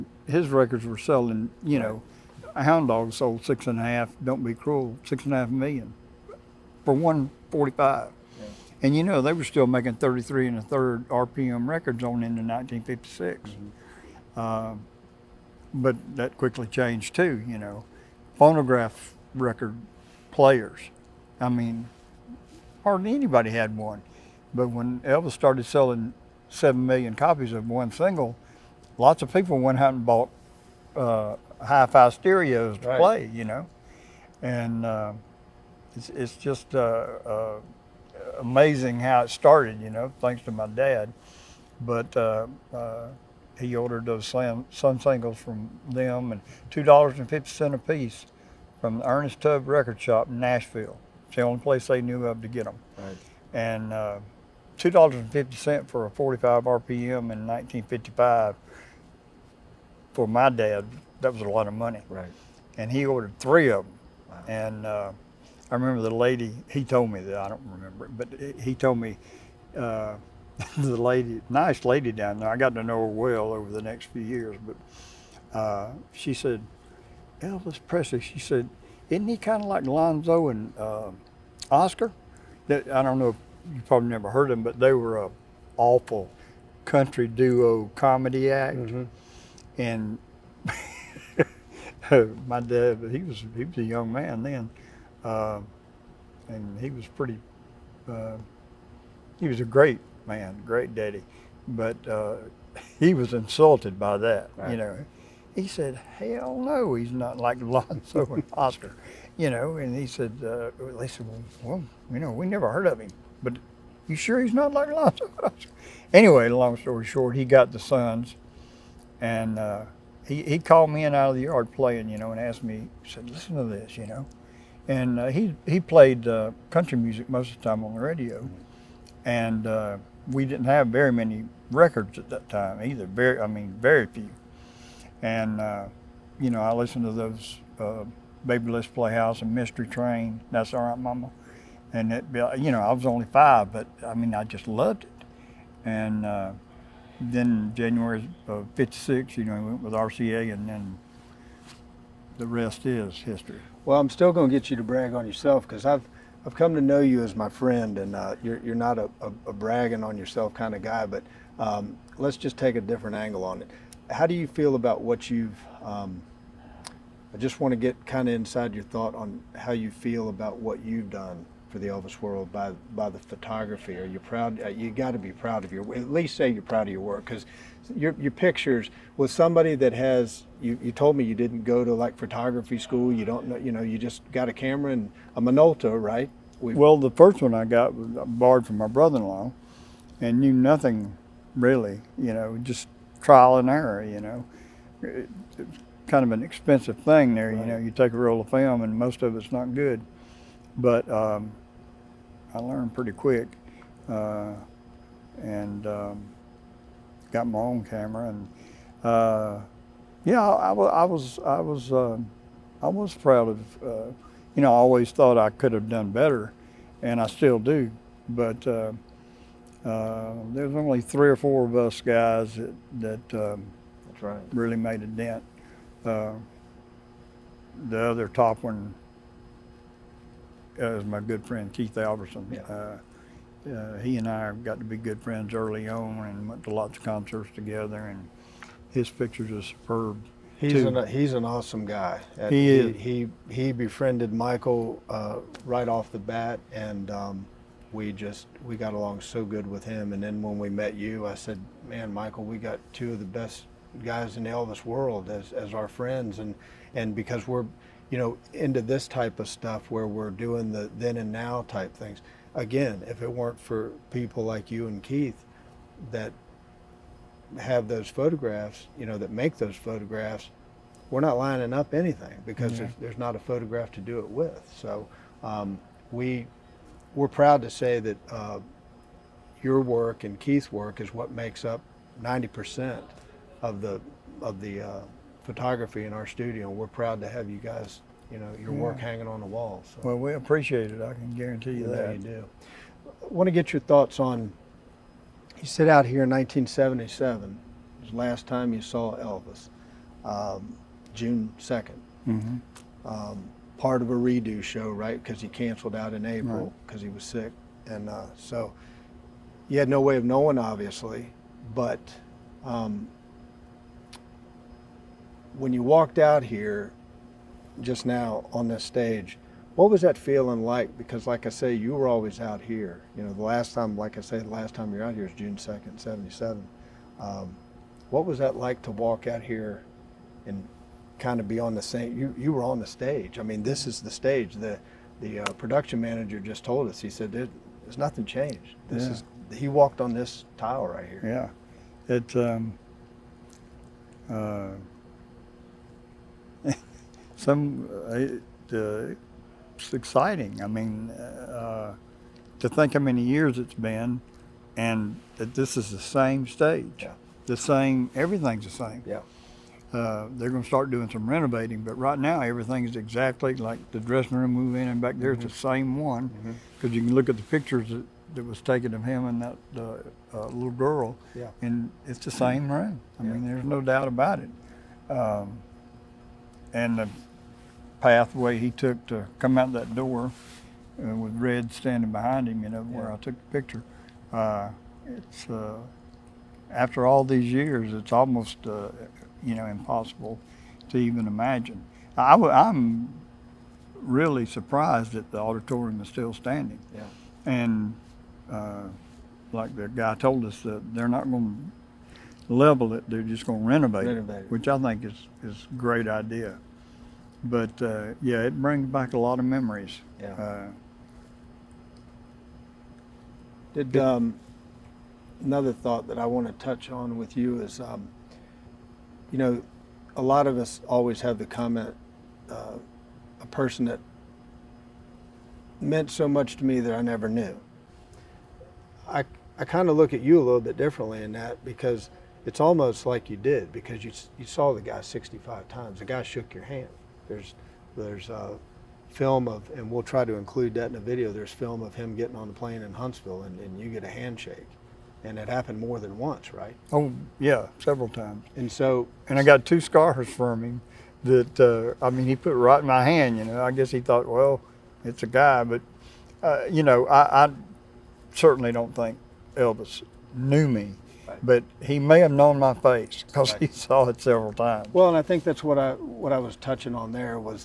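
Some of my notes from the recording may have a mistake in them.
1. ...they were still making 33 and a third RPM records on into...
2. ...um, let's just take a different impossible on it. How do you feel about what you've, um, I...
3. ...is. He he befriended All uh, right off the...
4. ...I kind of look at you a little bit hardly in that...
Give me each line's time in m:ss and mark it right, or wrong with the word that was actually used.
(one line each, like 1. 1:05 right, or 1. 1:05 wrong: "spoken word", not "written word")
1. 0:09 right
2. 2:41 wrong: "angle", not "impossible"
3. 4:02 wrong: "Michael", not "All"
4. 7:09 wrong: "differently", not "hardly".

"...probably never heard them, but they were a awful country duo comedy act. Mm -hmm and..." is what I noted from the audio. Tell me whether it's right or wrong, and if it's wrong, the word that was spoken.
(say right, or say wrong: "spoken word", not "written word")
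right.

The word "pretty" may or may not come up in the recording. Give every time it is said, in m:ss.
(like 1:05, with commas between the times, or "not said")
1:37, 3:22.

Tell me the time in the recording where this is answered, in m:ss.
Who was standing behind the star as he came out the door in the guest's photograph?
6:21.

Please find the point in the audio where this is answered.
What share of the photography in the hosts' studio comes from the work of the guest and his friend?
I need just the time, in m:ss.
4:42.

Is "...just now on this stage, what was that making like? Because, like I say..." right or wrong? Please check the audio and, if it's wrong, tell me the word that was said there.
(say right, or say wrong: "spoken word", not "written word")
wrong: "feeling", not "making".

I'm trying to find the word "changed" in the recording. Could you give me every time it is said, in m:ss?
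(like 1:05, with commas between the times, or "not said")
0:16, 5:38.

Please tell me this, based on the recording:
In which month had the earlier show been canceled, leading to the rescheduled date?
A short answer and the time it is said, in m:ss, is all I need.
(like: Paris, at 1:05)
April, at 5:06.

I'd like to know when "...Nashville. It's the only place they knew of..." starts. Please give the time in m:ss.
0:50.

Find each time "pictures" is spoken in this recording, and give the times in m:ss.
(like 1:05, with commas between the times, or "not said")
2:58, 3:59, 6:07, 6:23.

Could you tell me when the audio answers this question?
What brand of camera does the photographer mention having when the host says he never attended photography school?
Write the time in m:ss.
3:05.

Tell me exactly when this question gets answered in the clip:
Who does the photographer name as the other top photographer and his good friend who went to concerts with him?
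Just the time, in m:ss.
3:51.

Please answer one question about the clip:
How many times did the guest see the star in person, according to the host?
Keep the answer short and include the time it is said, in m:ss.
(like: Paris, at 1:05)
65, at 7:15.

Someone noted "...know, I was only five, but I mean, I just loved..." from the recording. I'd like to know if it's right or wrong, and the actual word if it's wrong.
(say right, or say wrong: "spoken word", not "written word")
right.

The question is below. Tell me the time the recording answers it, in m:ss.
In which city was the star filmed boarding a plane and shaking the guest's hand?
7:22.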